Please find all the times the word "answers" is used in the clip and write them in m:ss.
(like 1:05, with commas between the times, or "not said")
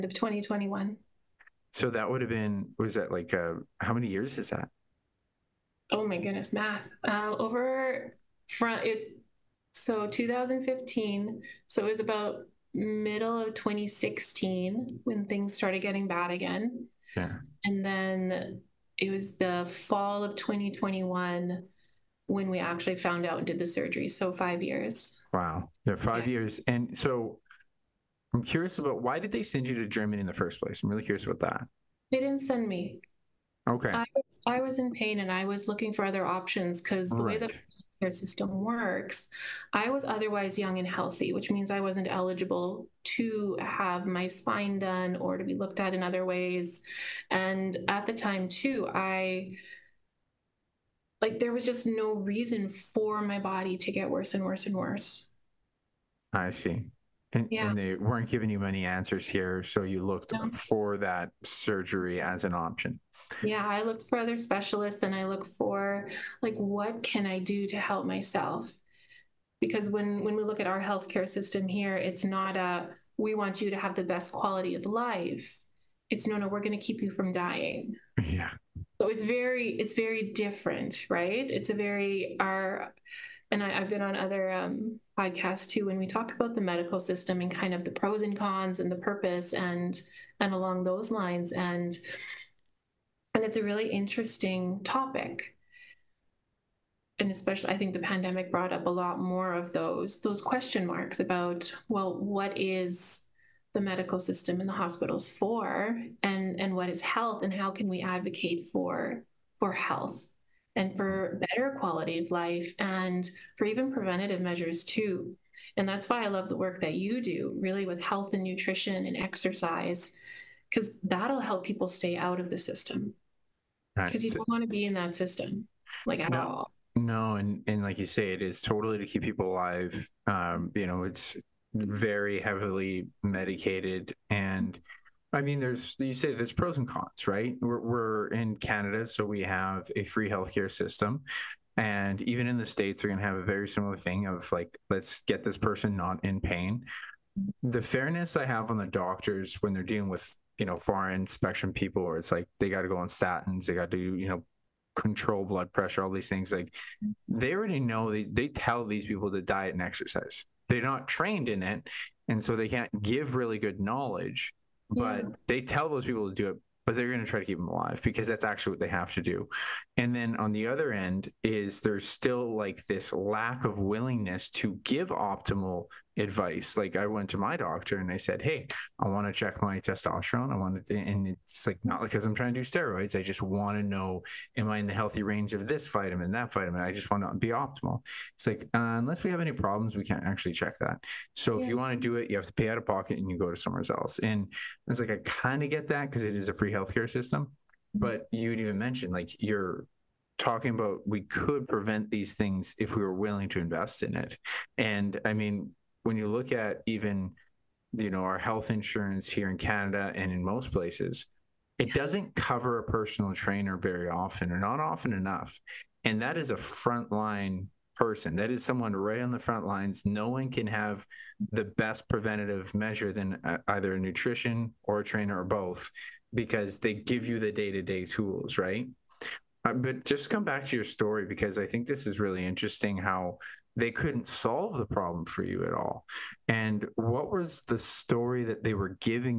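0:58.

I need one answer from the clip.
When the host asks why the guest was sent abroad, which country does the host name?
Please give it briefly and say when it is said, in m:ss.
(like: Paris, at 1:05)
Germany, at 0:29.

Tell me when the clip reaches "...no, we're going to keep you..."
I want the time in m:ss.
1:16.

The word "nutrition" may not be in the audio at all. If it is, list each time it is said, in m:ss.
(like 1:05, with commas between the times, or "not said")
1:58, 3:43.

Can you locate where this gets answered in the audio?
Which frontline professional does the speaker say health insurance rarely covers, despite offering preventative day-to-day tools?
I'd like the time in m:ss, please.
3:32.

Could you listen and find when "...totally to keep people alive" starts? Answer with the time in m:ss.
2:08.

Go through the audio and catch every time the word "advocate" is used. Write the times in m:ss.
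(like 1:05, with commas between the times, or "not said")
1:48.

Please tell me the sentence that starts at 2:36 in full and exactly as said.
Like they already know they they tell these people to diet and exercise.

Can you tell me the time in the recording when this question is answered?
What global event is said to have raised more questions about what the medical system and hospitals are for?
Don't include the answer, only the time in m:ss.
1:37.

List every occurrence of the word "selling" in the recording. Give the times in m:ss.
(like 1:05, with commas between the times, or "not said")
not said.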